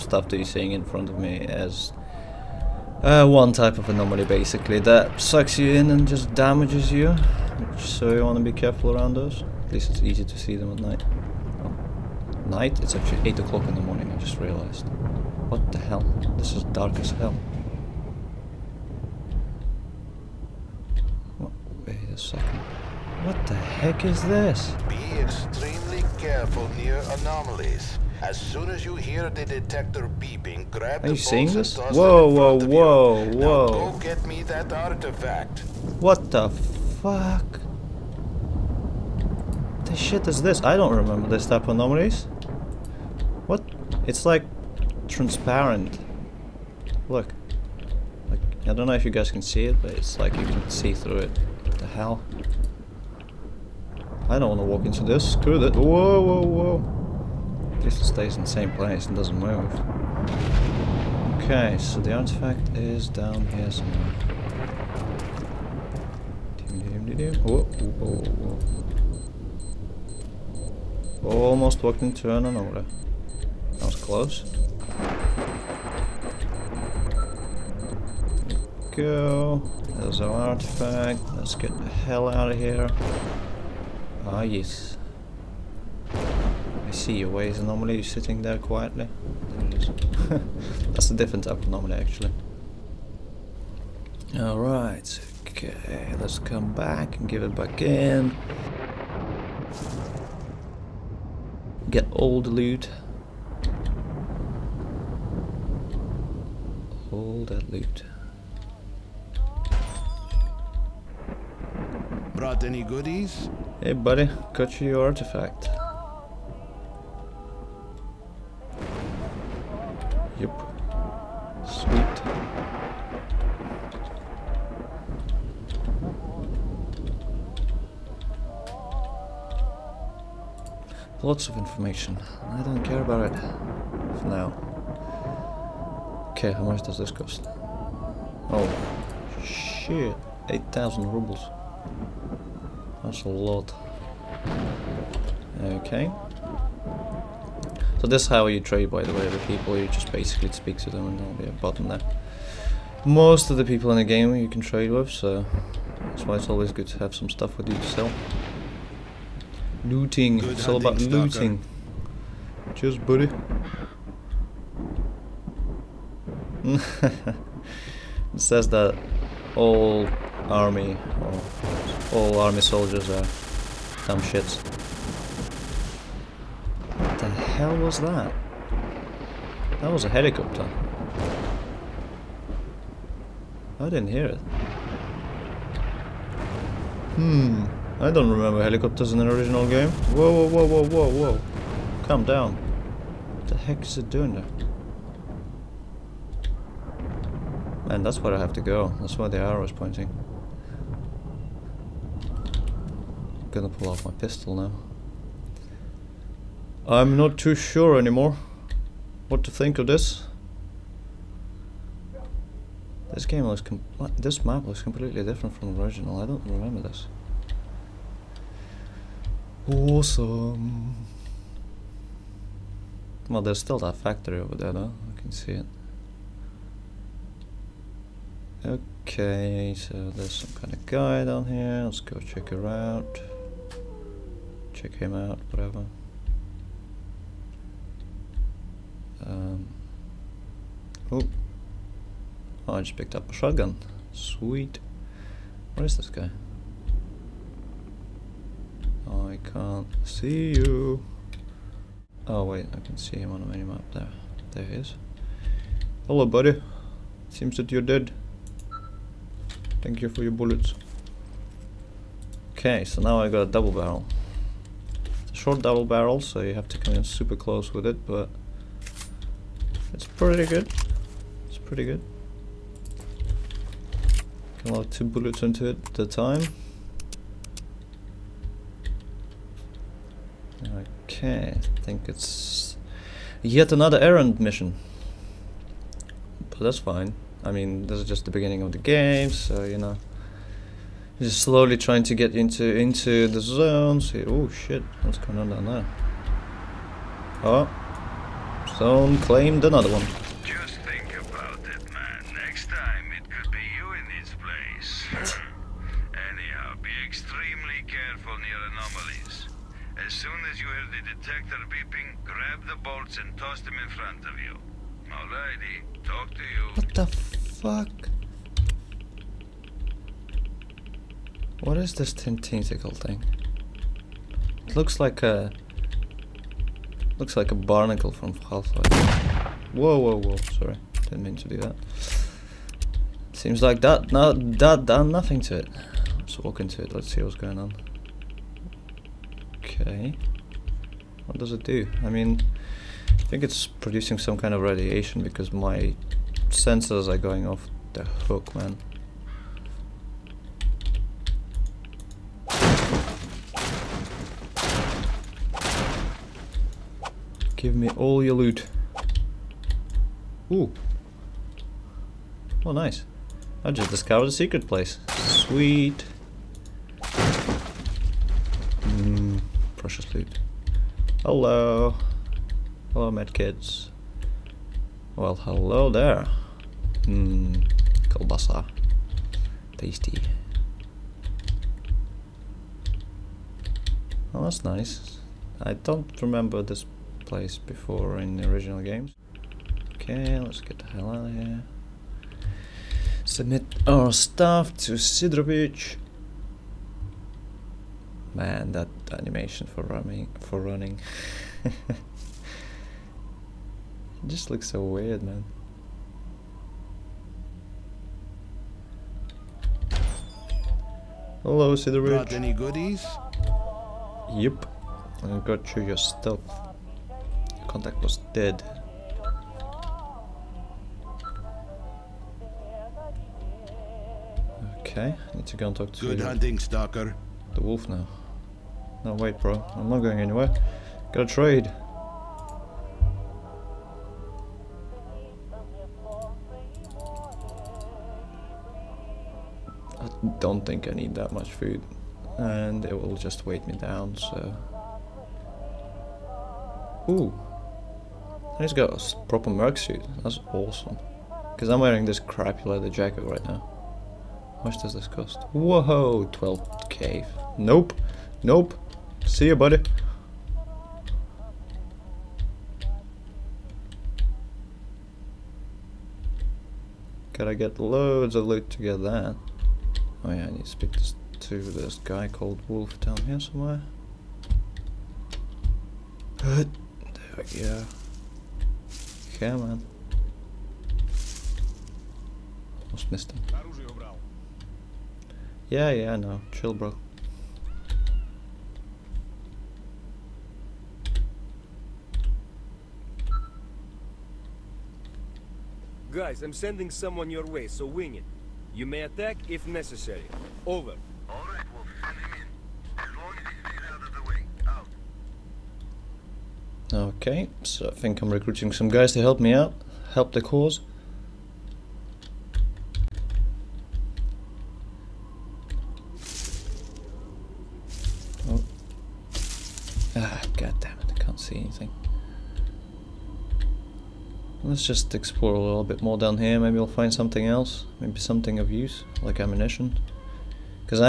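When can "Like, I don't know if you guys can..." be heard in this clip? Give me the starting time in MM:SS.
00:48.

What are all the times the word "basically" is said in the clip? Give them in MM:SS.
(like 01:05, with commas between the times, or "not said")
00:04, 02:30.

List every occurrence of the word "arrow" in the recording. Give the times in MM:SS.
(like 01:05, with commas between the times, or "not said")
03:19.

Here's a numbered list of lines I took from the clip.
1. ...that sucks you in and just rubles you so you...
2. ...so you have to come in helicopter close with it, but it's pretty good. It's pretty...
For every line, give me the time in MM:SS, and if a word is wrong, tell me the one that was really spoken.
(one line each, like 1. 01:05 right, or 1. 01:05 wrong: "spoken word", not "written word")
1. 00:04 wrong: "damages", not "rubles"
2. 04:26 wrong: "super", not "helicopter".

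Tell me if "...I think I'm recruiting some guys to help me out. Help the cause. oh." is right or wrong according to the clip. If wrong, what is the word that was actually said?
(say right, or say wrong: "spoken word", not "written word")
right.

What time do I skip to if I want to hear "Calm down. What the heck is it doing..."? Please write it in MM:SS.
03:12.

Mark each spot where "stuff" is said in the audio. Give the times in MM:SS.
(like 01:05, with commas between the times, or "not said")
02:37, 06:34, 06:55.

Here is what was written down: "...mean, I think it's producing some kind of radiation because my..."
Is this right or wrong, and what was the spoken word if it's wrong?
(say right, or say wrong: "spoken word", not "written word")
right.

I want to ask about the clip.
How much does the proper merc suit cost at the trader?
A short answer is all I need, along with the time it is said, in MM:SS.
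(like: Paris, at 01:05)
12k, at 07:36.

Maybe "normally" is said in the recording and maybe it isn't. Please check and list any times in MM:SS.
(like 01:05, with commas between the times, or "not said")
01:27, 01:31.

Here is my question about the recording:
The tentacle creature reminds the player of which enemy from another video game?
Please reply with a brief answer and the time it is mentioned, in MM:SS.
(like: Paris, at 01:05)
barnacle, at 05:27.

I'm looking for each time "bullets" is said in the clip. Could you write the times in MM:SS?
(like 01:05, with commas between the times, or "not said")
04:20, 04:35.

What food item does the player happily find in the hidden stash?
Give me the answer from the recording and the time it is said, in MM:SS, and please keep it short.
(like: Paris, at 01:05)
kielbasa, at 06:18.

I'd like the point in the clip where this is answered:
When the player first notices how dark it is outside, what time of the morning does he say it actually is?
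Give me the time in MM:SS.
00:13.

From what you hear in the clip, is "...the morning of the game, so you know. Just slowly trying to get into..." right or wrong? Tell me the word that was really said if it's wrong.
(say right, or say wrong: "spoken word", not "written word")
wrong: "beginning", not "morning".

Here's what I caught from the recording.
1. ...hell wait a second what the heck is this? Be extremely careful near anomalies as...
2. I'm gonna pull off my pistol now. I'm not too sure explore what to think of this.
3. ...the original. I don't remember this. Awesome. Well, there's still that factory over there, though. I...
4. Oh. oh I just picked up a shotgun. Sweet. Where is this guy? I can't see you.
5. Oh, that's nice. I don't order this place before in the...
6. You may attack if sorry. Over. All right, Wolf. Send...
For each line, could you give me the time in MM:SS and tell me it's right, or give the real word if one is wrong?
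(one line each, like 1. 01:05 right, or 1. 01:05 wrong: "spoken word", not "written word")
1. 00:17 right
2. 03:23 wrong: "anymore", not "explore"
3. 03:35 right
4. 04:01 right
5. 06:24 wrong: "remember", not "order"
6. 08:18 wrong: "necessary", not "sorry".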